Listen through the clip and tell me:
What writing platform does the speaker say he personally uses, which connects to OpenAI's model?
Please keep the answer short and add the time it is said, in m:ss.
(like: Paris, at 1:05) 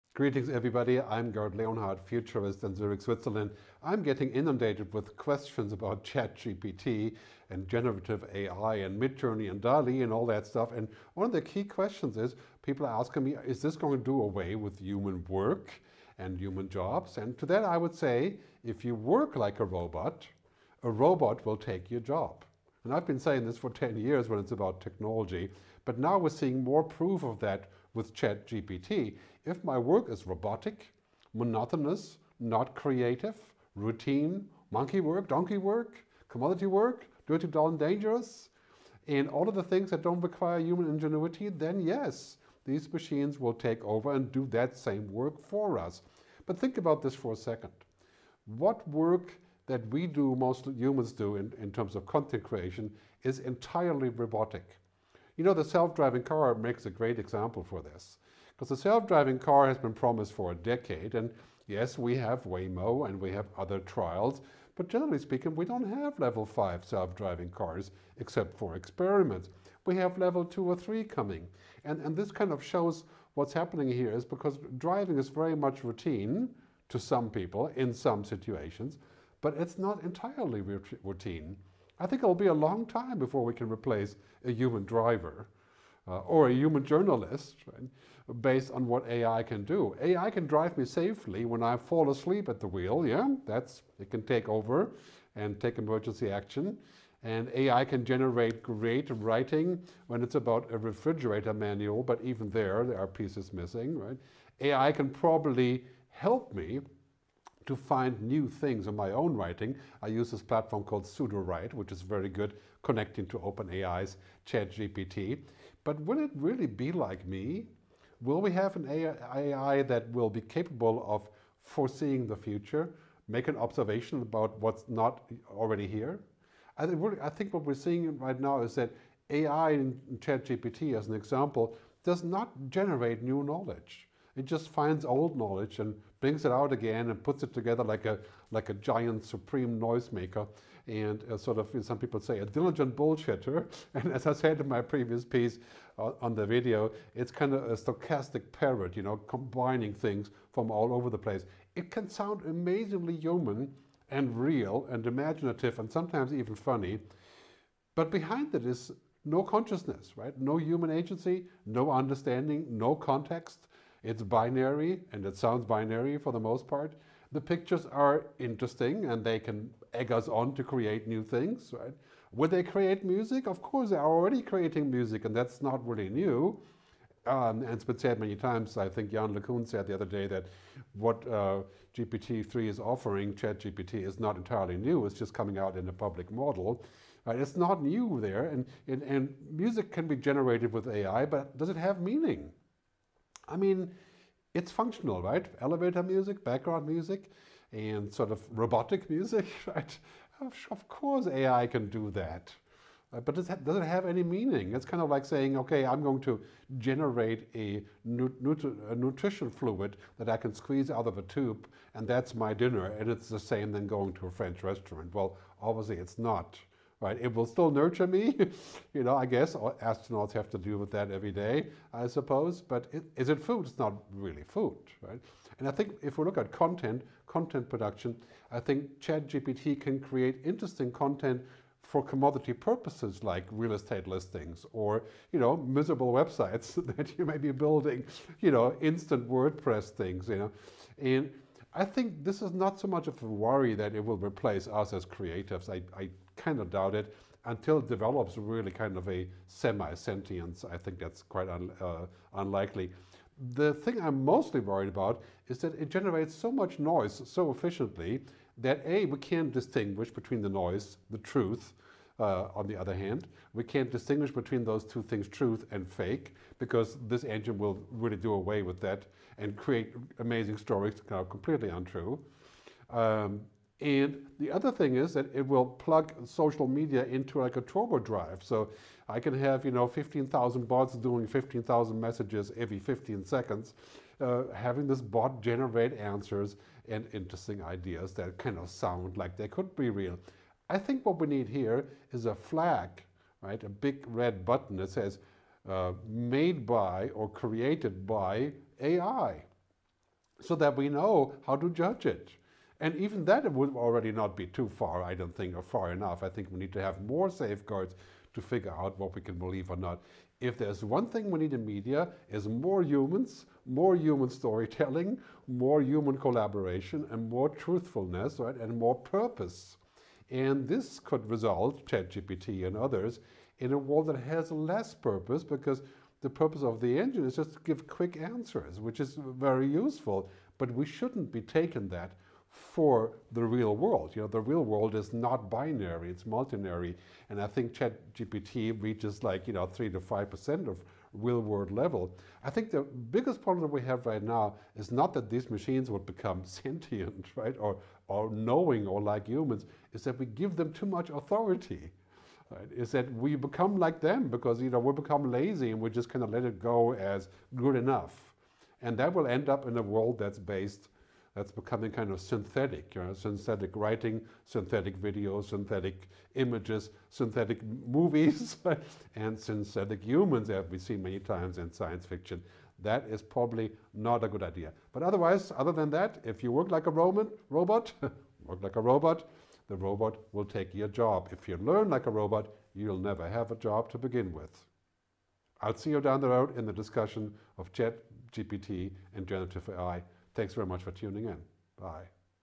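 Sudowrite, at 1:51.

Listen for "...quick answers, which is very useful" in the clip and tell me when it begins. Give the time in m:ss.
5:27.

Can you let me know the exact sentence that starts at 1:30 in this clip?
AI can drive me safely when I fall asleep at the wheel, yeah?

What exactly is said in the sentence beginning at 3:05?
It's just coming out in a public model.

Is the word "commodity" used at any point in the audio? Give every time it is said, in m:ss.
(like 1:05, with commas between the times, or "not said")
0:36, 3:52.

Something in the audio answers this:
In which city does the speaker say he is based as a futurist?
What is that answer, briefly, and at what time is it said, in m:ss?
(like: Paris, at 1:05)
Zurich, at 0:02.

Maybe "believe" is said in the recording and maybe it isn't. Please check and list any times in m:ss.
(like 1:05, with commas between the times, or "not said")
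5:09.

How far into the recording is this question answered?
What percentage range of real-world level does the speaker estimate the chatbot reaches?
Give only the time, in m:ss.
5:39.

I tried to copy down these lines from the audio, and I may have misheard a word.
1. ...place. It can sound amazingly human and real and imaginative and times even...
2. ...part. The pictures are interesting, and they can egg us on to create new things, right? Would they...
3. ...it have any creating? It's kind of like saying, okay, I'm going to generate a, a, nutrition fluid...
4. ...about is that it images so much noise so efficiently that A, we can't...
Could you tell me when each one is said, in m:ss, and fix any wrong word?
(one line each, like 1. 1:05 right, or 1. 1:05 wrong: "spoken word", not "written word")
1. 2:31 wrong: "sometimes", not "times"
2. 2:46 right
3. 3:23 wrong: "meaning", not "creating"
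4. 4:14 wrong: "generates", not "images".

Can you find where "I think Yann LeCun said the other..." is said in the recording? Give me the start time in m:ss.
2:58.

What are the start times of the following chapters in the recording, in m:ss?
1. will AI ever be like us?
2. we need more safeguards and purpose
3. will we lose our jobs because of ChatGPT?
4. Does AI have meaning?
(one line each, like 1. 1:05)
1. 1:56
2. 4:13
3. 0:12
4. 3:11.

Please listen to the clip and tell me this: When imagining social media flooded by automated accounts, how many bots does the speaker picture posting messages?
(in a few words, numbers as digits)
15,000.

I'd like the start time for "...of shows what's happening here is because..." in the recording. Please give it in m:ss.
1:12.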